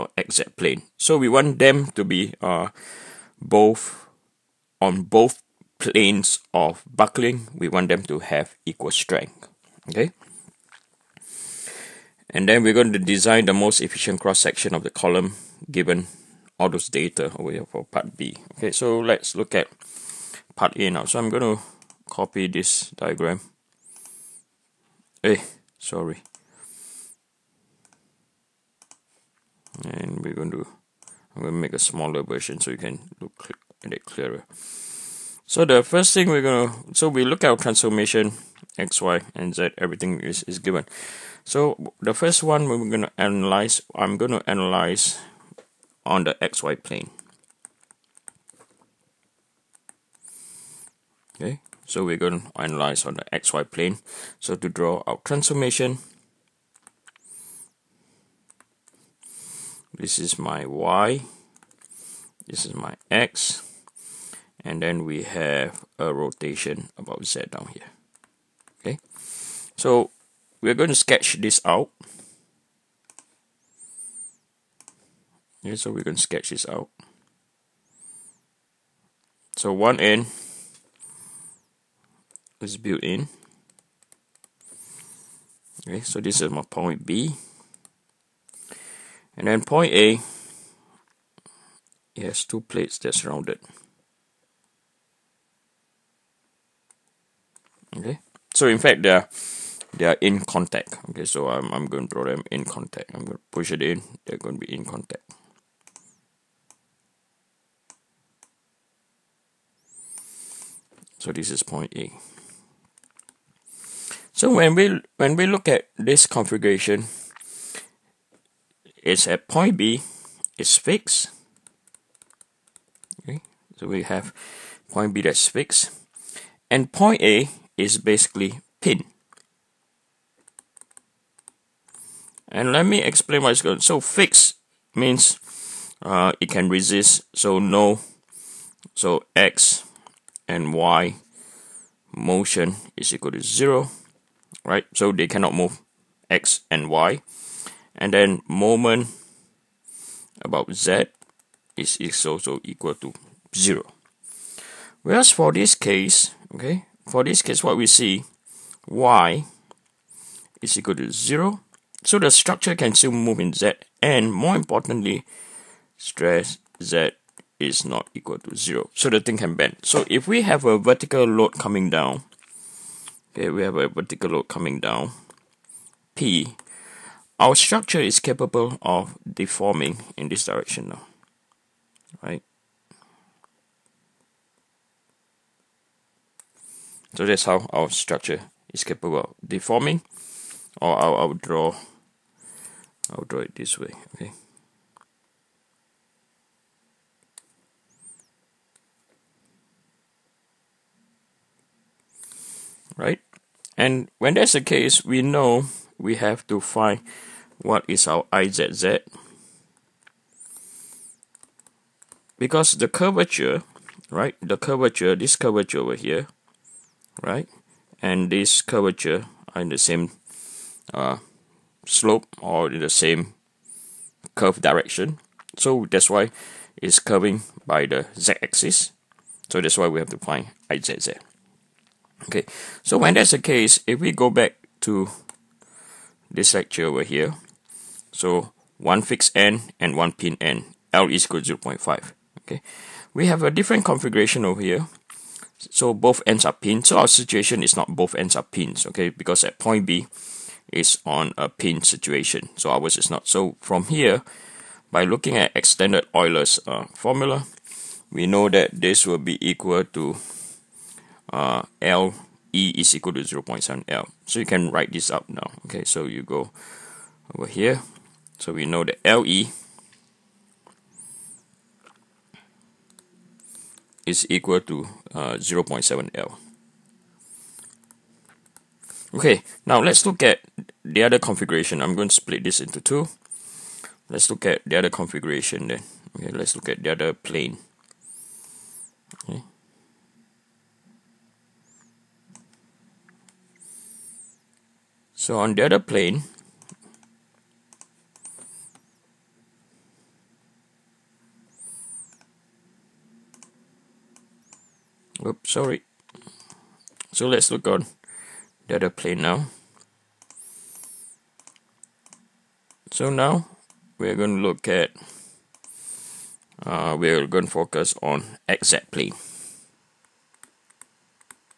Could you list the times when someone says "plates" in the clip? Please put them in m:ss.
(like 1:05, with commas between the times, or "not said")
1:32.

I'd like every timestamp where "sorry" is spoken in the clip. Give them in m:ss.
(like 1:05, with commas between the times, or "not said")
0:25, 5:05.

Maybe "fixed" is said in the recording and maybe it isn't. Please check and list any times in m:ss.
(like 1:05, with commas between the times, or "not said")
2:00, 2:05, 3:59.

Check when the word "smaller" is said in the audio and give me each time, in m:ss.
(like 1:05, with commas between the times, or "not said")
0:31.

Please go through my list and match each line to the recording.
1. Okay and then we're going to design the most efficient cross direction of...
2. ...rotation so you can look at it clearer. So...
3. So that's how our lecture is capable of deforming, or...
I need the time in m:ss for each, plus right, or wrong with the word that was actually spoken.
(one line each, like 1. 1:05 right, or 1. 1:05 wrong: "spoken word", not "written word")
1. 0:09 wrong: "section", not "direction"
2. 0:32 wrong: "version", not "rotation"
3. 3:07 wrong: "structure", not "lecture".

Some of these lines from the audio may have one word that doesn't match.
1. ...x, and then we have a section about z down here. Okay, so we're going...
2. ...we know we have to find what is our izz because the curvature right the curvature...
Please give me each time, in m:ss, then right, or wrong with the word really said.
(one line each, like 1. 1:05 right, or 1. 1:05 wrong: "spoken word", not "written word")
1. 1:03 wrong: "rotation", not "section"
2. 3:25 right.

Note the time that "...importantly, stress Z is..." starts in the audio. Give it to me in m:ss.
2:44.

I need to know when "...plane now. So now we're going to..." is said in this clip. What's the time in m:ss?
5:08.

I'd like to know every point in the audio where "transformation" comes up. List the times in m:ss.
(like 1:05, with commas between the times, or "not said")
0:37, 0:55.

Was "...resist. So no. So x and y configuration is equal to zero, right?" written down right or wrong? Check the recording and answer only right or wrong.
wrong.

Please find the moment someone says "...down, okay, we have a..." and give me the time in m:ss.
2:51.